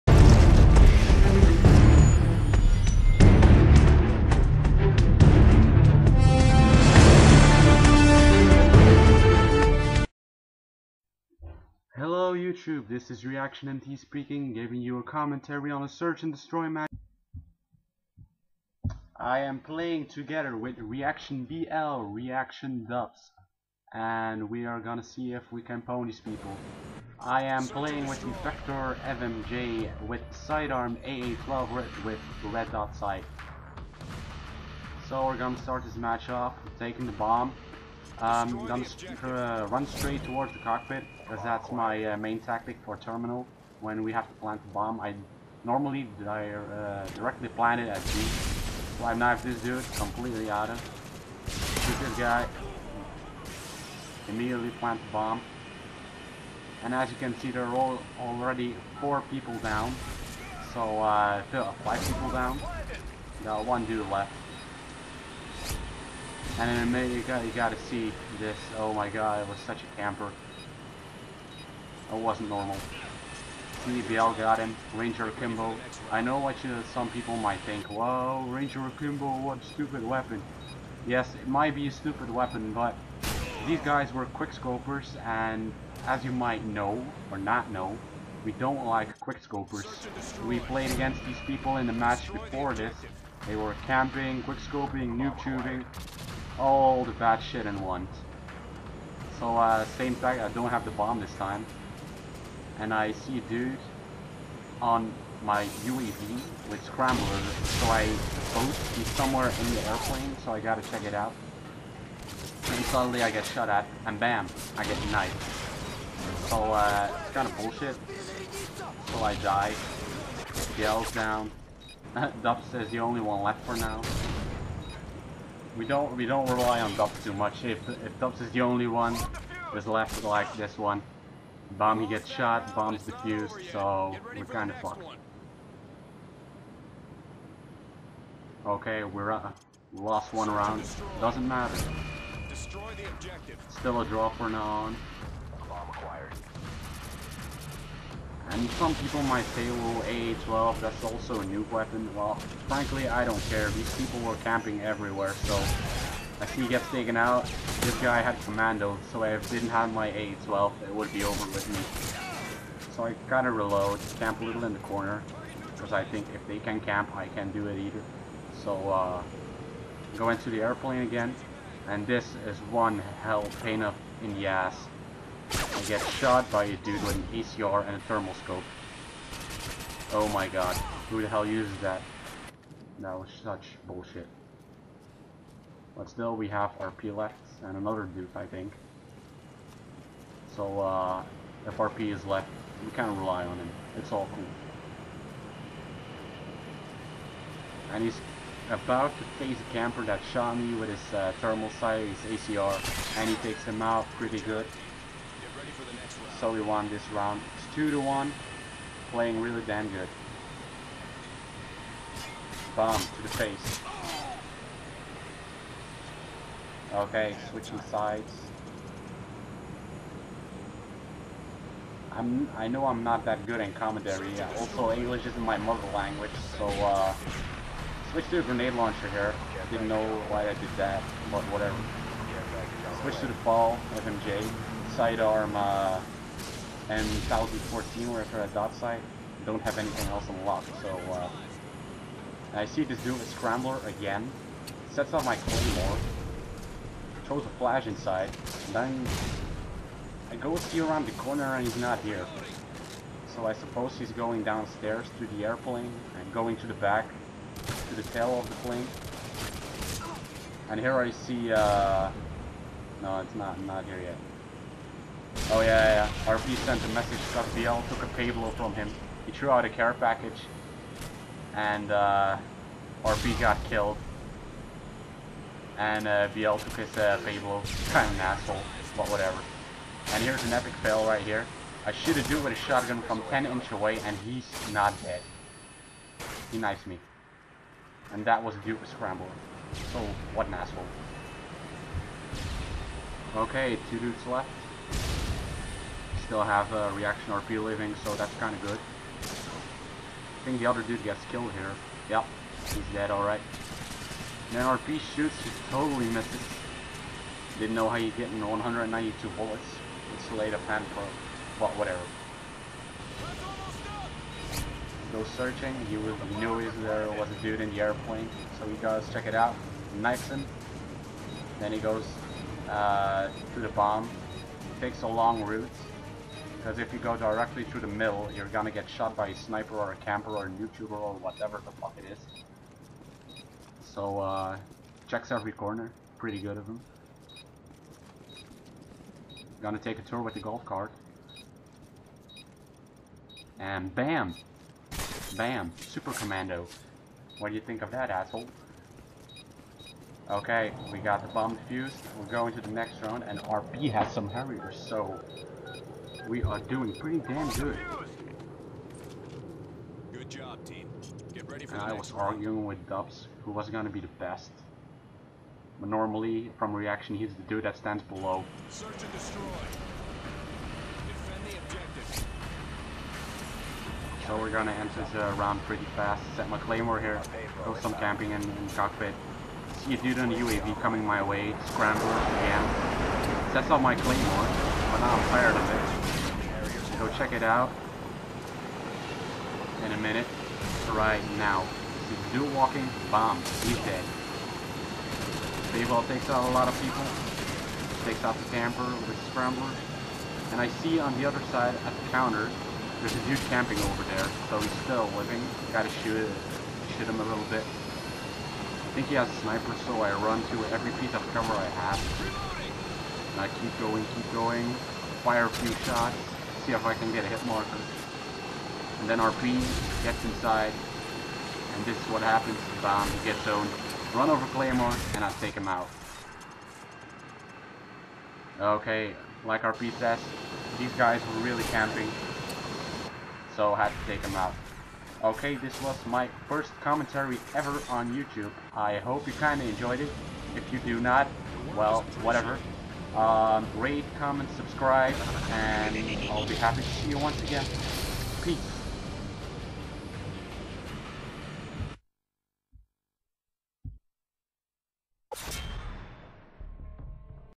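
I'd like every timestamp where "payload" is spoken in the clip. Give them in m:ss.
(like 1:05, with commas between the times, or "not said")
4:28, 4:37.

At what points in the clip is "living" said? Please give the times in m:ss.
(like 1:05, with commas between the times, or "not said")
4:57, 6:45.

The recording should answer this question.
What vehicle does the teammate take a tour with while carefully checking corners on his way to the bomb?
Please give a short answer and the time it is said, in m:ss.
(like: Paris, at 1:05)
golf cart, at 5:40.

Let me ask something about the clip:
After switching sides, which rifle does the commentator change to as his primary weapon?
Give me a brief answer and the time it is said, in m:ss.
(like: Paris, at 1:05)
FAL, at 3:53.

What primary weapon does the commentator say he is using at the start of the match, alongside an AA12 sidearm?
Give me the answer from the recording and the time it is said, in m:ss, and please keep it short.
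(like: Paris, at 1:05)
Vector FMJ, at 0:28.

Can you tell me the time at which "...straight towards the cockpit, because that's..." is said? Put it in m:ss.
0:39.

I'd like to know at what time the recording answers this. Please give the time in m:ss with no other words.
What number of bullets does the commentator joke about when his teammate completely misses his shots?
5:08.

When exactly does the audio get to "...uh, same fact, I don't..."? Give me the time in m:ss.
1:39.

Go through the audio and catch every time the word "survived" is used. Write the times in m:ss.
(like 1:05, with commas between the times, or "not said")
not said.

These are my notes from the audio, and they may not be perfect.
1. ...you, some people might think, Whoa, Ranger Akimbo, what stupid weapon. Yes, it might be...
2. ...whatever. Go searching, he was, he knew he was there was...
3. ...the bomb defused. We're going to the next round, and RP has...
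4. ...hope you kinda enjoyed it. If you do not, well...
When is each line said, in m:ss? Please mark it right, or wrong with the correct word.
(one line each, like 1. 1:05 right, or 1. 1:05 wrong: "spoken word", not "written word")
1. 1:16 right
2. 5:11 right
3. 5:51 right
4. 7:18 right.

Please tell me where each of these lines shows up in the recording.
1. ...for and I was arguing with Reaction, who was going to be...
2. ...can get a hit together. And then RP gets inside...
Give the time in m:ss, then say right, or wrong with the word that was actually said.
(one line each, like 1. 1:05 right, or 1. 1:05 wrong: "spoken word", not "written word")
1. 6:01 wrong: "Dubz", not "Reaction"
2. 6:56 wrong: "marker", not "together".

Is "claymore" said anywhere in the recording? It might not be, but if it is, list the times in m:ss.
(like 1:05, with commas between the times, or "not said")
4:05, 6:16, 6:23, 7:04.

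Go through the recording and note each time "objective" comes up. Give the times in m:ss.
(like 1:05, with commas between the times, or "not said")
6:11.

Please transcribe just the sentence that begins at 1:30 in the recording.
We played against these people in the match before this.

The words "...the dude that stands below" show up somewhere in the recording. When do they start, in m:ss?
6:07.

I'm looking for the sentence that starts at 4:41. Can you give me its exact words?
I shoot a dude with a shotgun from 10 inch away, and he's not dead.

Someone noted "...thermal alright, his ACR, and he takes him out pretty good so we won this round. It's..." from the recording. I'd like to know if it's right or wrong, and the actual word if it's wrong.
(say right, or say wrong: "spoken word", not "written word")
wrong: "sight", not "alright".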